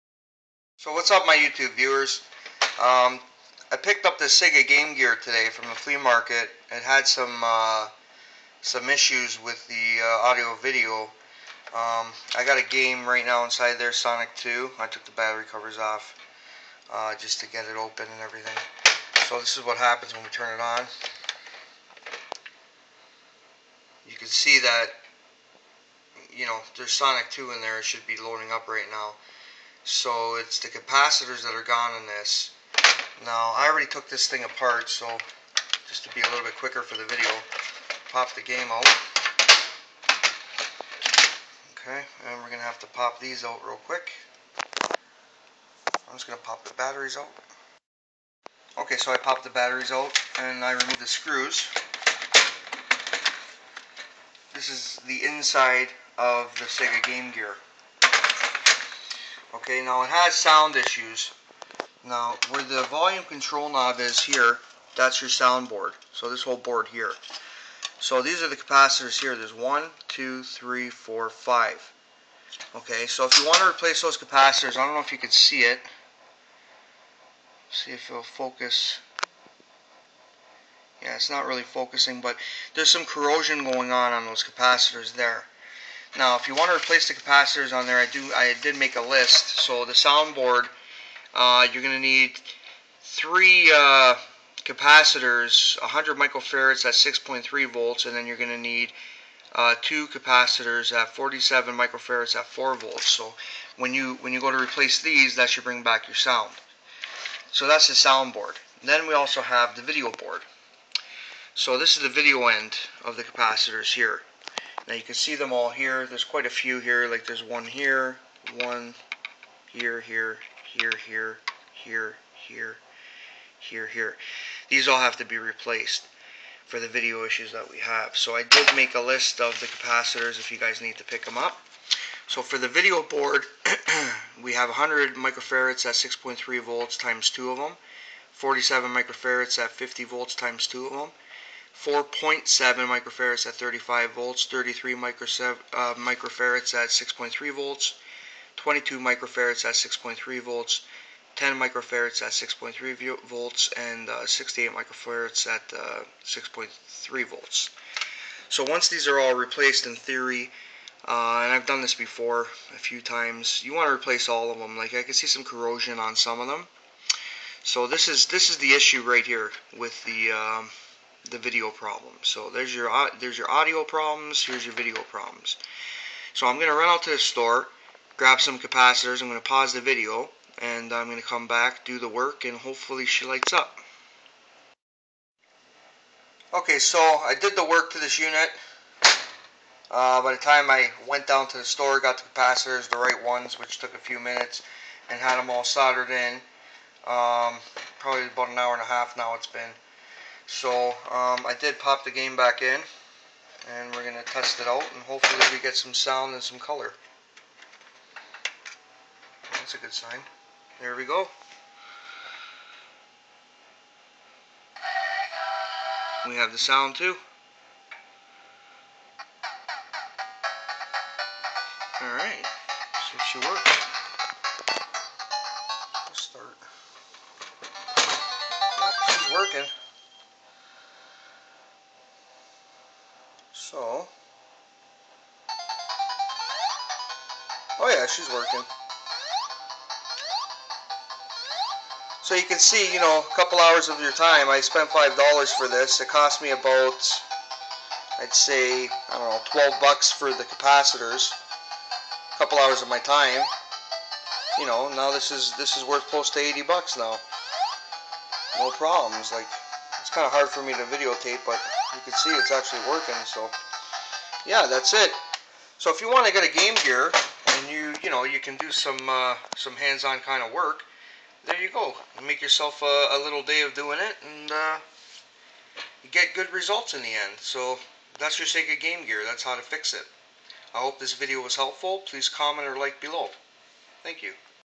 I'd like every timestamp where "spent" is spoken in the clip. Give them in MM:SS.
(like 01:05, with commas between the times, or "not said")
04:04.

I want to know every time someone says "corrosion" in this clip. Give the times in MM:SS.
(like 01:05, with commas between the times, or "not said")
01:23, 02:45.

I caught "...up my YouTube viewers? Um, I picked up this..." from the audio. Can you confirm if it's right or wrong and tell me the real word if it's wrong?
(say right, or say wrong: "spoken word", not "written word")
right.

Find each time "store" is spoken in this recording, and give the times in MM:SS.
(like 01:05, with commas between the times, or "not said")
02:57, 03:11.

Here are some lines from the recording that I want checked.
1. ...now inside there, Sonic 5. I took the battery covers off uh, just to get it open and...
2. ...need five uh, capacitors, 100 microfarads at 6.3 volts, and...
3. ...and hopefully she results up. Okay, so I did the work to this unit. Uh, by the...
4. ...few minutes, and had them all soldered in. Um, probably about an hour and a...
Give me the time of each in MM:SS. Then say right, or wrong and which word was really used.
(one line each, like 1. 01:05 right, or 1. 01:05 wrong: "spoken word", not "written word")
1. 00:13 wrong: "2", not "5"
2. 01:32 wrong: "three", not "five"
3. 03:02 wrong: "lights", not "results"
4. 03:13 right.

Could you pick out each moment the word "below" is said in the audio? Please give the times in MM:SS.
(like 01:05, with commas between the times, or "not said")
04:43.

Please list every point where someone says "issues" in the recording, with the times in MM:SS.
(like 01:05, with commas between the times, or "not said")
00:08, 01:00, 02:07, 02:48.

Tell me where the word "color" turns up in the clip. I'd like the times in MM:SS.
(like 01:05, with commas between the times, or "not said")
03:26.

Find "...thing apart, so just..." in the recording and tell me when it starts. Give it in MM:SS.
00:34.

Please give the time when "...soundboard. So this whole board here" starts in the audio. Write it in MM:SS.
01:05.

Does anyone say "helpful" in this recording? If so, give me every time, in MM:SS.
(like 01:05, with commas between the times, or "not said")
04:41.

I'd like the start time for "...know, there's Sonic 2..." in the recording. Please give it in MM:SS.
00:26.